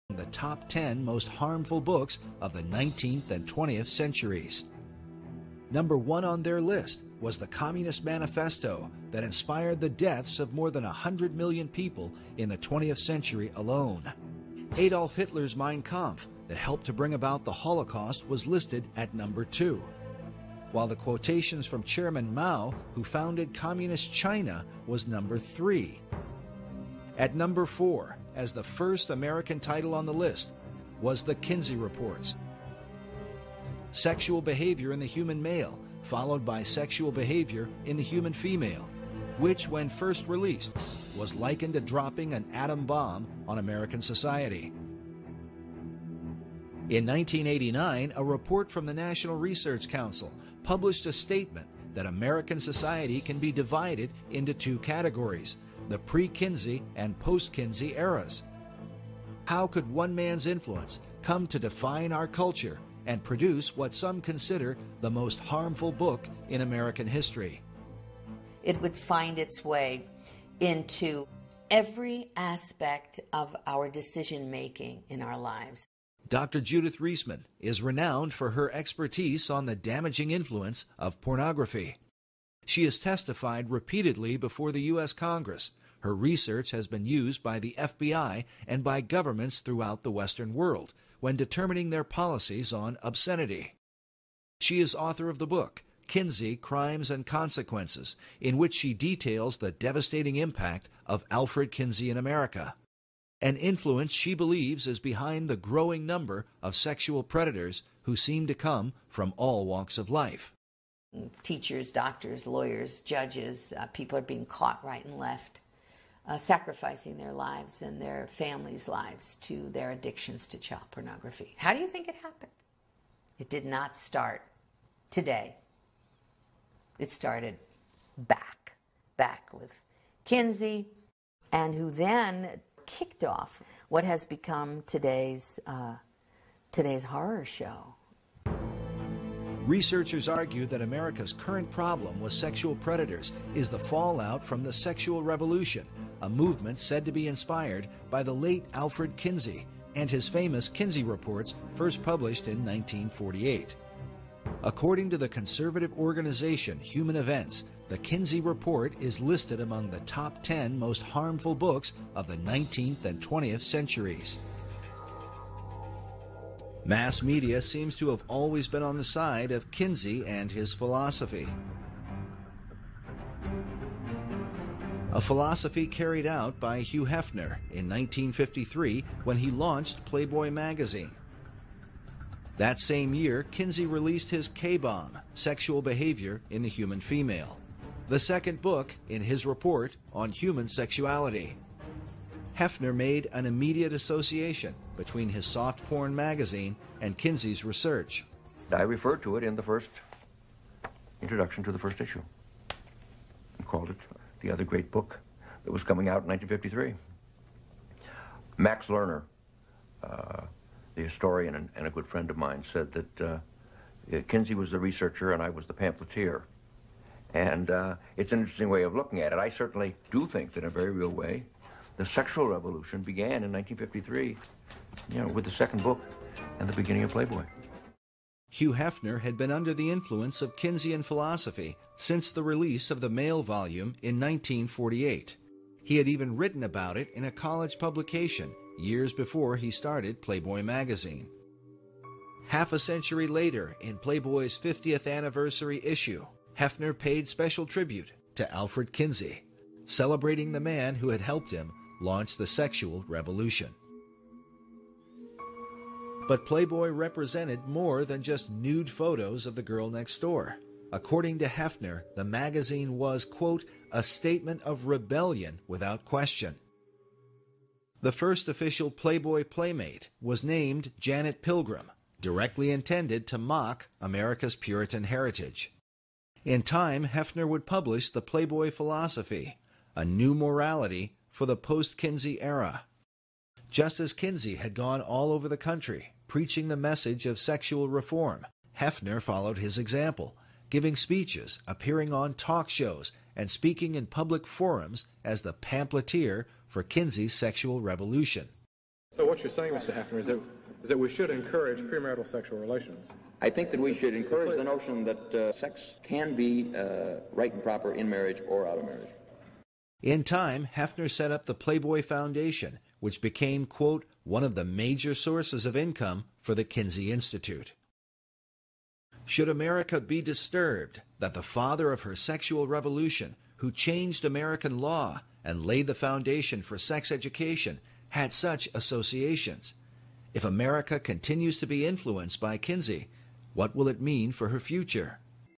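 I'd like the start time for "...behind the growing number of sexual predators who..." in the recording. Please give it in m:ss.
1:44.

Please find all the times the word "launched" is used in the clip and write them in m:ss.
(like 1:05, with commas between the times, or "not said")
2:59, 4:12.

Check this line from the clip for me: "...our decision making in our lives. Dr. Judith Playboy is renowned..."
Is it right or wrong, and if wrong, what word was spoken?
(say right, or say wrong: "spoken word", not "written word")
wrong: "Reisman", not "Playboy".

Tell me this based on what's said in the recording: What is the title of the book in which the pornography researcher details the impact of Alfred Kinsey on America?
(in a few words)
Kinsey Crimes and Consequences.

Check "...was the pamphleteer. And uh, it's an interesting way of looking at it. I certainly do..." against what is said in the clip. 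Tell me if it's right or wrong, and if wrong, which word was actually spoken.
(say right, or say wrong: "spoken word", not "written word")
right.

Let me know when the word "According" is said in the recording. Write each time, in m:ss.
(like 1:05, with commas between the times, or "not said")
2:34, 4:20.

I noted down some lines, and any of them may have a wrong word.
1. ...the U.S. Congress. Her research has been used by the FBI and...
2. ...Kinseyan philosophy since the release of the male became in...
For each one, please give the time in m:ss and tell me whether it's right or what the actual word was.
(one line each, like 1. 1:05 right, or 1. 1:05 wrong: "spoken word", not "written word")
1. 1:24 right
2. 3:50 wrong: "volume", not "became".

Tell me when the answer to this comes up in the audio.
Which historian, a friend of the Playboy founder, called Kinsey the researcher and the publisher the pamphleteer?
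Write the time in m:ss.
3:28.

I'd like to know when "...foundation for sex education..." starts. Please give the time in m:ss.
5:25.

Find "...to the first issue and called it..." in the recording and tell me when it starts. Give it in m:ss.
3:21.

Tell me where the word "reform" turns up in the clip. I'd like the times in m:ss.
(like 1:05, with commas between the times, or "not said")
4:47.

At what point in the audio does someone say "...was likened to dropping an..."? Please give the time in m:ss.
0:41.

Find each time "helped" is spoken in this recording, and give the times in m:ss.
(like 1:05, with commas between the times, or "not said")
0:16, 4:11.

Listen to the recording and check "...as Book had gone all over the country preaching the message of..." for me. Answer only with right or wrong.
wrong.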